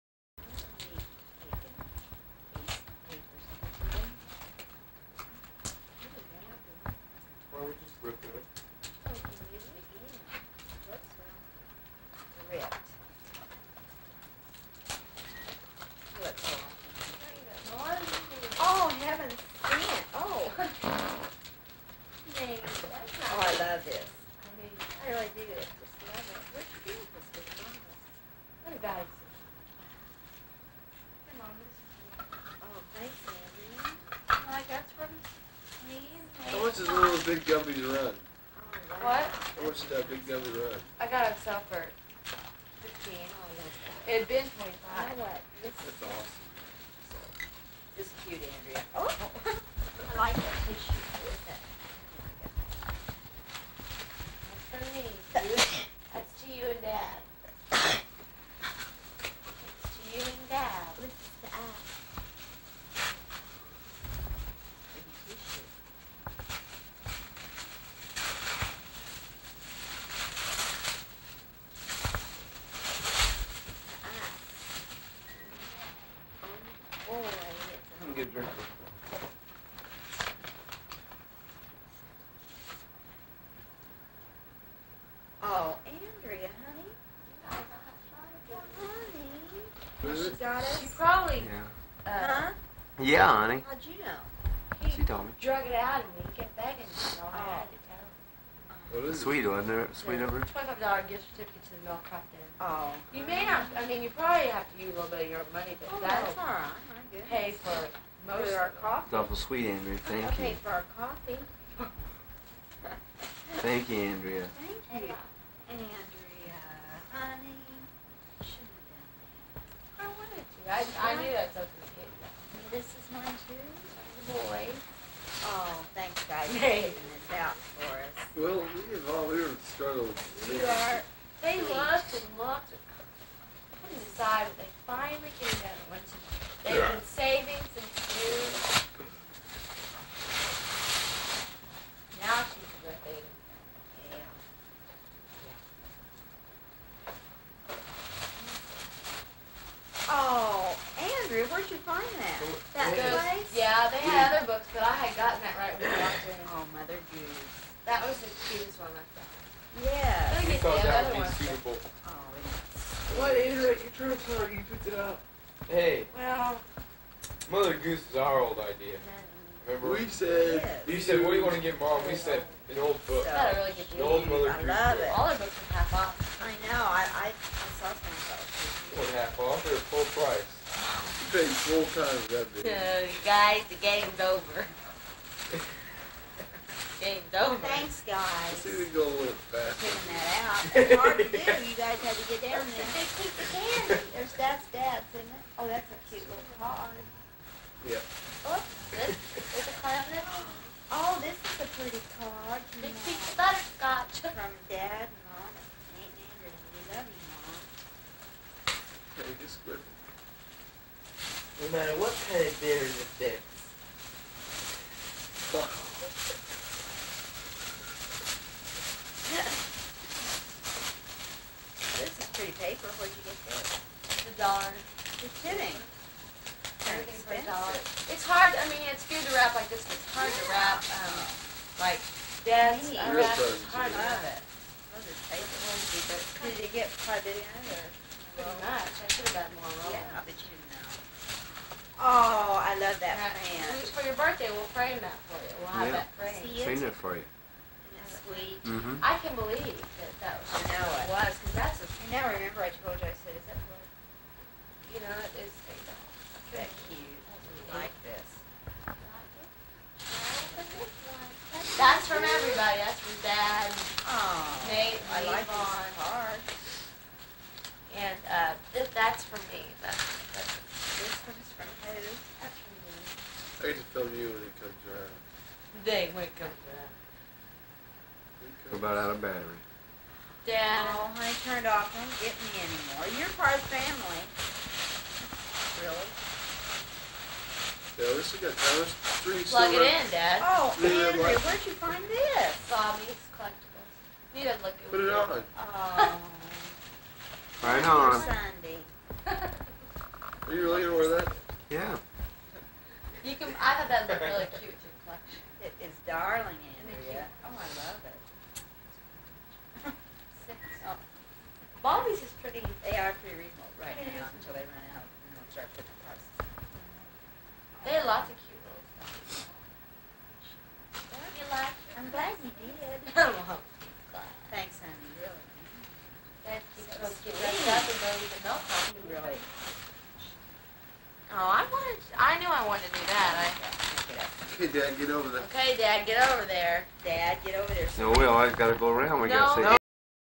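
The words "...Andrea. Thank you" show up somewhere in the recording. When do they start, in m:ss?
1:53.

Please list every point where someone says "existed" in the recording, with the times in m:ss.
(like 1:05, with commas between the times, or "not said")
not said.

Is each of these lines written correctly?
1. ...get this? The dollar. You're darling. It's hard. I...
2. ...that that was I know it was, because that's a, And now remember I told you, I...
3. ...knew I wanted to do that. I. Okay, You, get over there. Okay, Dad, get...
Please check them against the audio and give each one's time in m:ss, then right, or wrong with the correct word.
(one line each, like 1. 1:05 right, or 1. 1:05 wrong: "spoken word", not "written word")
1. 3:43 wrong: "kidding", not "darling"
2. 4:09 right
3. 5:32 wrong: "Dad", not "You".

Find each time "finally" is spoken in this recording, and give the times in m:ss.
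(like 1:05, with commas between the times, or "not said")
2:14.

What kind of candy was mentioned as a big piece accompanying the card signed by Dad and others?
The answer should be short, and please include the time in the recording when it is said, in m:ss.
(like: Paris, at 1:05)
Butterscotch, at 3:23.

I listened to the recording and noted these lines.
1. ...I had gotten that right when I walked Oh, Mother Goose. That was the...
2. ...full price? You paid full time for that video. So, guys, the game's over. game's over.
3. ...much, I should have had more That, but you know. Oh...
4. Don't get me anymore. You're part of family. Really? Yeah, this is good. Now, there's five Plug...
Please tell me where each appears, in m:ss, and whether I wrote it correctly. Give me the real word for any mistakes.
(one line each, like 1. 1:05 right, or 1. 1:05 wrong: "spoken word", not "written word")
1. 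2:34 right
2. 2:59 right
3. 3:58 wrong: "Yeah", not "That"
4. 4:41 wrong: "three", not "five".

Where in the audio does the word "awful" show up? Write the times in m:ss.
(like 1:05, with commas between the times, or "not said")
1:49.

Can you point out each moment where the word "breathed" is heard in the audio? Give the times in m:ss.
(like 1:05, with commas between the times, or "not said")
not said.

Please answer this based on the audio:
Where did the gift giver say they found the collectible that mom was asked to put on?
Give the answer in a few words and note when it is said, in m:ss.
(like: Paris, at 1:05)
Bobby's collectibles, at 4:52.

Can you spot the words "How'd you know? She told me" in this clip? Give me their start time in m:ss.
1:33.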